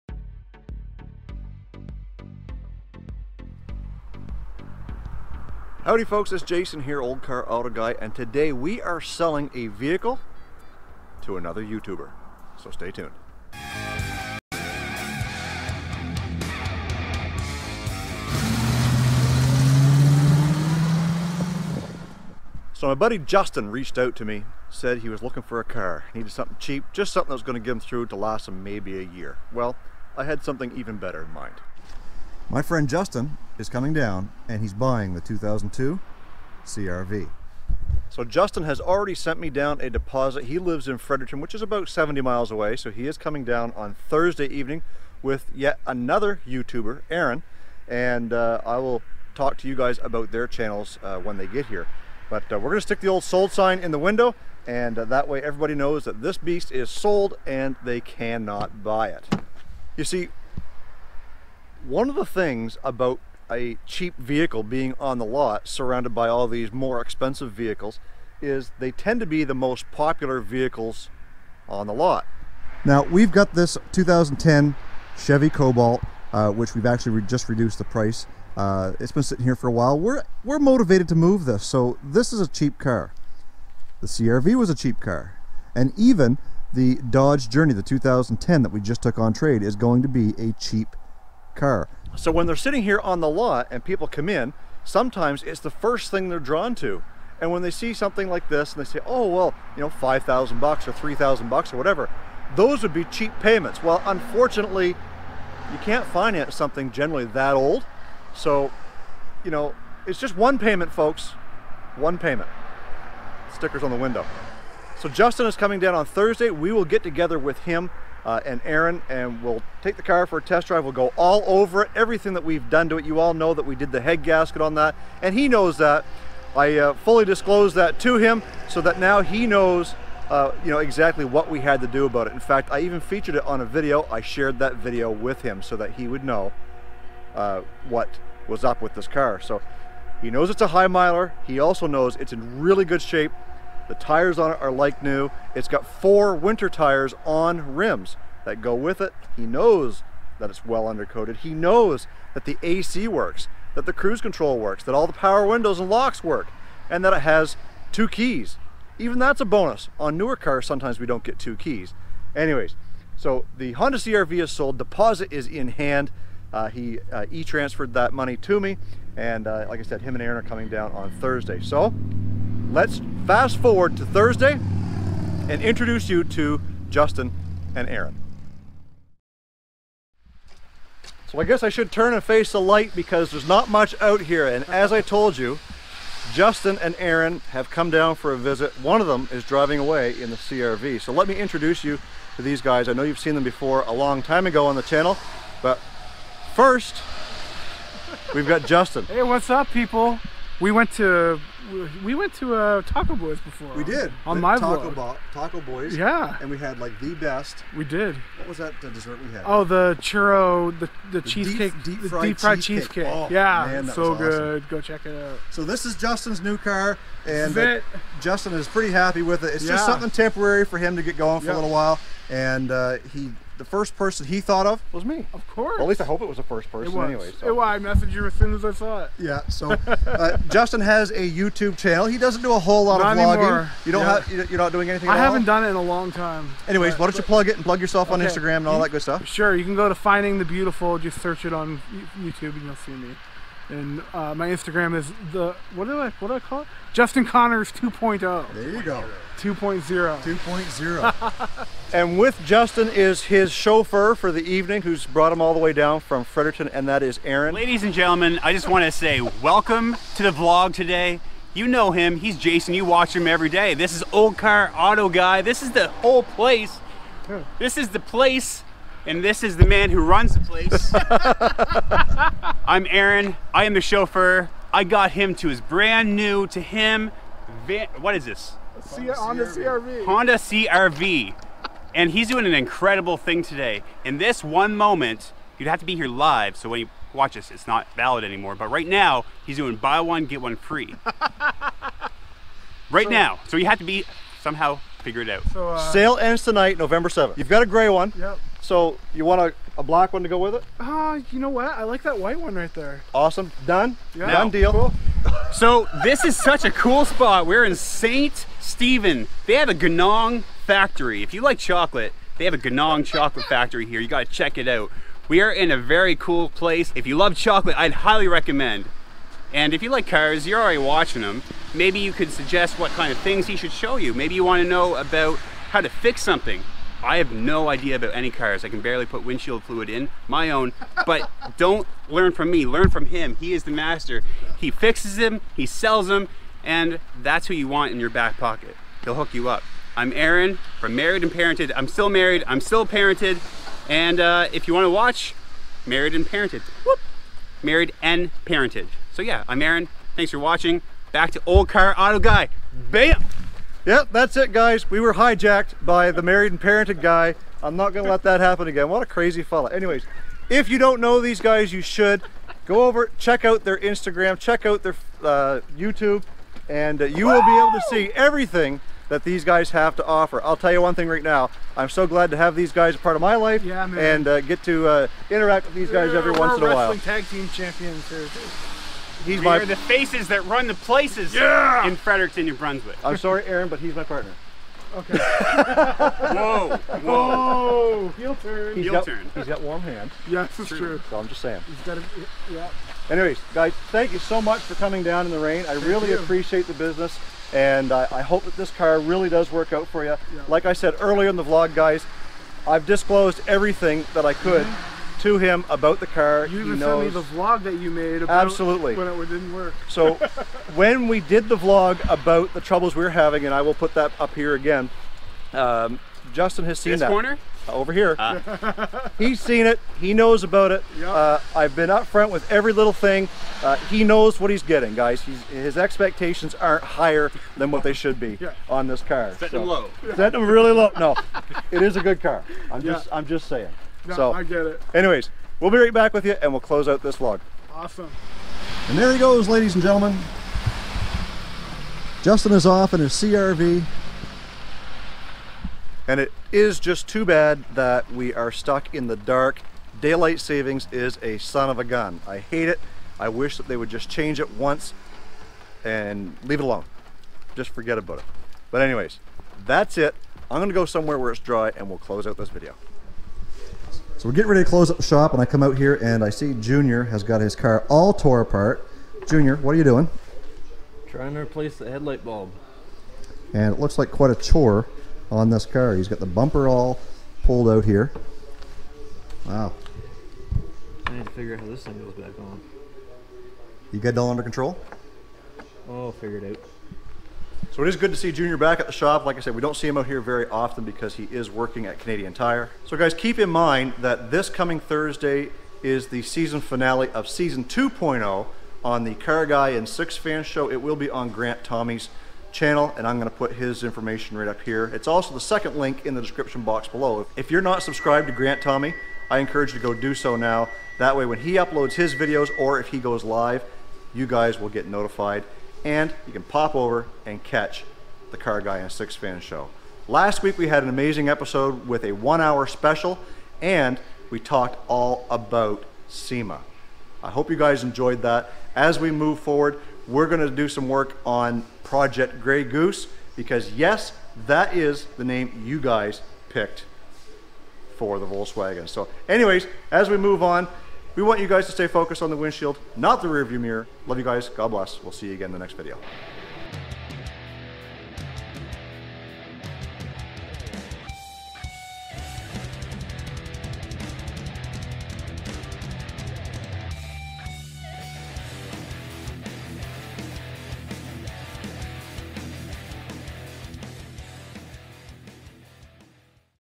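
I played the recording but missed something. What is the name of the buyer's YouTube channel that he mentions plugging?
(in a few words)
Finding the Beautiful.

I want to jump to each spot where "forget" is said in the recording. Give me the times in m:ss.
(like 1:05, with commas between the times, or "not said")
7:37.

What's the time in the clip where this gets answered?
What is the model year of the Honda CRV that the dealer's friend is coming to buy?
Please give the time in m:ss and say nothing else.
0:35.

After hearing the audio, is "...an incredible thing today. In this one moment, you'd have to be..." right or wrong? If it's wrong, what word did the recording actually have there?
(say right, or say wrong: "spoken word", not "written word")
right.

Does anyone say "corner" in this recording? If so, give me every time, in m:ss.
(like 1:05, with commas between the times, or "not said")
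6:57.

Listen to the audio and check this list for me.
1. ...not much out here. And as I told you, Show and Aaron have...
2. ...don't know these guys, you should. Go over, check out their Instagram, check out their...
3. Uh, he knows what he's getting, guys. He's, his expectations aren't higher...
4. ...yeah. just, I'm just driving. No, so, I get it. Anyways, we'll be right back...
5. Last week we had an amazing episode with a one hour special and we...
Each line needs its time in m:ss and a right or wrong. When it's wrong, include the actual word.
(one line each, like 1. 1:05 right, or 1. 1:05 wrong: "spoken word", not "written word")
1. 3:03 wrong: "Justin", not "Show"
2. 6:00 right
3. 7:03 right
4. 7:12 wrong: "saying", not "driving"
5. 8:40 right.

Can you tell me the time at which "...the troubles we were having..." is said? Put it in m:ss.
6:52.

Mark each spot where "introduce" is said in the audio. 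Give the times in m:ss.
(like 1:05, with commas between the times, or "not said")
2:55, 3:11.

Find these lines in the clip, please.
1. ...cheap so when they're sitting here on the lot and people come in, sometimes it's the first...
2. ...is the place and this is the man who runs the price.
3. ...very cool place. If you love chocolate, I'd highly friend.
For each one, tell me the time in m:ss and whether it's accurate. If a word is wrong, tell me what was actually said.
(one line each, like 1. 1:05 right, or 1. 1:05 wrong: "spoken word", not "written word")
1. 1:30 right
2. 4:27 wrong: "place", not "price"
3. 5:15 wrong: "recommend", not "friend".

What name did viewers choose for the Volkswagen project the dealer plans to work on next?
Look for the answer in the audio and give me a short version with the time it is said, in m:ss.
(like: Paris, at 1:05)
Project Grey Goose, at 8:51.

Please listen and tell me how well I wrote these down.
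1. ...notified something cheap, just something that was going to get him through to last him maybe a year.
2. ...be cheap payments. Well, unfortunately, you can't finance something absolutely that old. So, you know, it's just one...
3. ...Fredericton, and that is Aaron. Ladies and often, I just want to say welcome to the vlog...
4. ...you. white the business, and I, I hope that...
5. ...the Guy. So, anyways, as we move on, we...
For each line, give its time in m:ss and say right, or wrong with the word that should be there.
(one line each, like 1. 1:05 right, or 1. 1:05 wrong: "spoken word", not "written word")
1. 0:26 wrong: "needed", not "notified"
2. 1:42 wrong: "generally", not "absolutely"
3. 4:16 wrong: "gentlemen", not "often"
4. 6:36 wrong: "appreciate", not "white"
5. 8:58 wrong: "Volkswagen", not "Guy".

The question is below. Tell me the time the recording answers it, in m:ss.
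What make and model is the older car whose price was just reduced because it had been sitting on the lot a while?
1:15.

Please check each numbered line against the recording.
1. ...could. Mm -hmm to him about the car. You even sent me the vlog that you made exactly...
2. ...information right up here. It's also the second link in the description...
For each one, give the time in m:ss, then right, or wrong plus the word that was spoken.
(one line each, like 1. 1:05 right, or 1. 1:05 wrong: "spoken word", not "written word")
1. 6:44 wrong: "absolutely", not "exactly"
2. 8:23 right.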